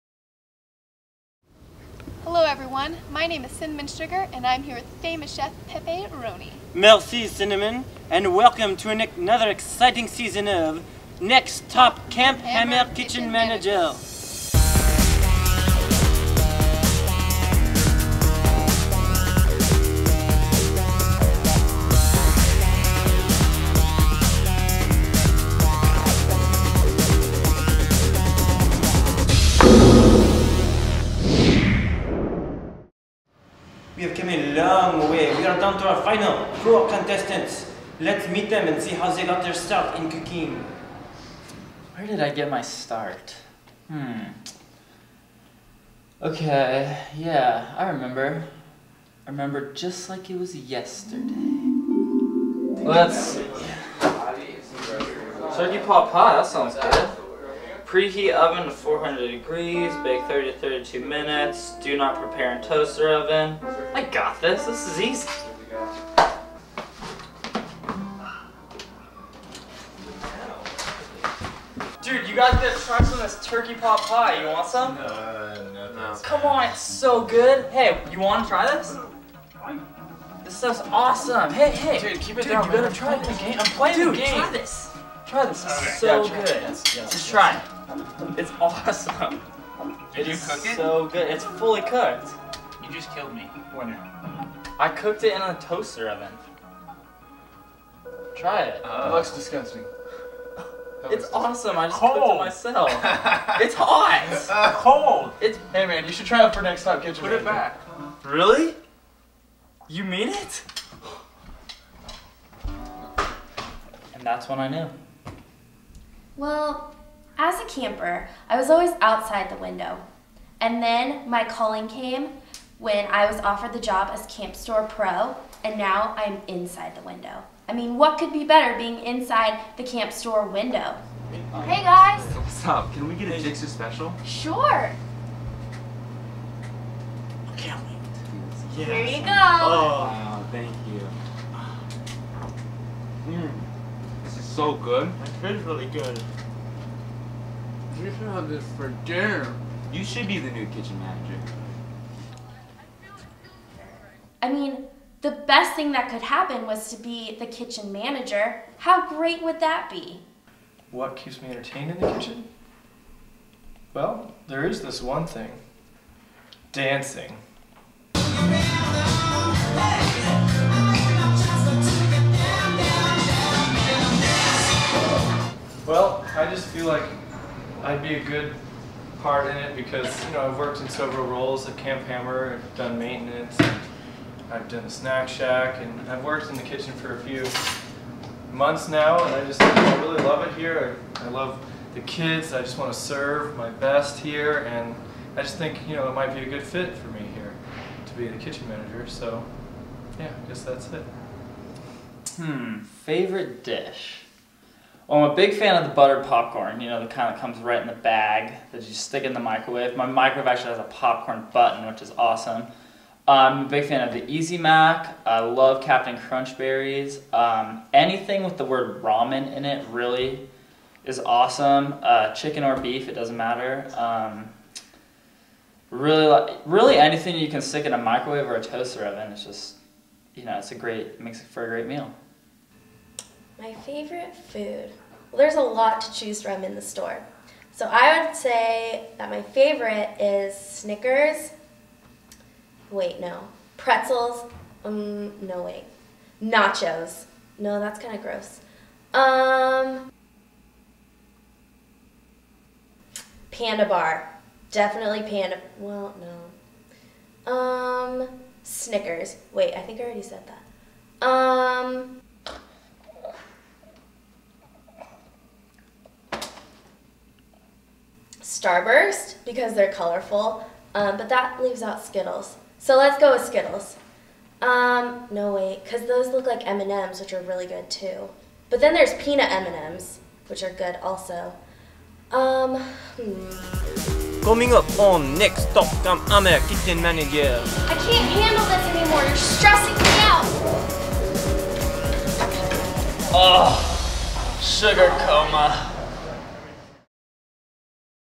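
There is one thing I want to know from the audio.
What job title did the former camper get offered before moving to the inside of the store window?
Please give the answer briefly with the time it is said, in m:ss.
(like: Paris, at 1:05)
Camp Store Pro, at 2:04.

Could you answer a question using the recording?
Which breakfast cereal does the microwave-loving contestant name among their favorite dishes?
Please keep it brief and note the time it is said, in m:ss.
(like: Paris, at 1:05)
Captain Crunch Berries, at 3:35.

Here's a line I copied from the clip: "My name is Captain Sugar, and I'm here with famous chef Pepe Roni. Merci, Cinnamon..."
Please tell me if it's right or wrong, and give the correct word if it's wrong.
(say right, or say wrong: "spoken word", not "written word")
wrong: "Cinnamon", not "Captain".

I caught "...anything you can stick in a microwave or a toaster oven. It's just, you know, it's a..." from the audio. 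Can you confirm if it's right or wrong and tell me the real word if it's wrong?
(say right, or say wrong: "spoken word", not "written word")
right.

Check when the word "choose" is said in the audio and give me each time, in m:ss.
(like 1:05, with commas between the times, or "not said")
3:56.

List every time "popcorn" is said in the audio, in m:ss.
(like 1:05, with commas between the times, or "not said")
3:26, 3:30.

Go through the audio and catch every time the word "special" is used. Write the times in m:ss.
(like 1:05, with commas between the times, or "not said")
2:13.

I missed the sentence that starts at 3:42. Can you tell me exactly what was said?
Uh, chicken or beef, it doesn't matter.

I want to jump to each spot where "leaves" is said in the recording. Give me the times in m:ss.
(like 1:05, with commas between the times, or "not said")
4:31.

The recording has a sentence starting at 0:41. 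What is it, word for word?
Where did I get my start?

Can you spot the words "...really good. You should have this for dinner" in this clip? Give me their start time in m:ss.
2:25.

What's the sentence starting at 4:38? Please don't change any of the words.
But then there's peanut M&Ms, which are good also.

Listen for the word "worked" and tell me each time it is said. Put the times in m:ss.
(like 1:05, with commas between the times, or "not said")
3:00, 3:06.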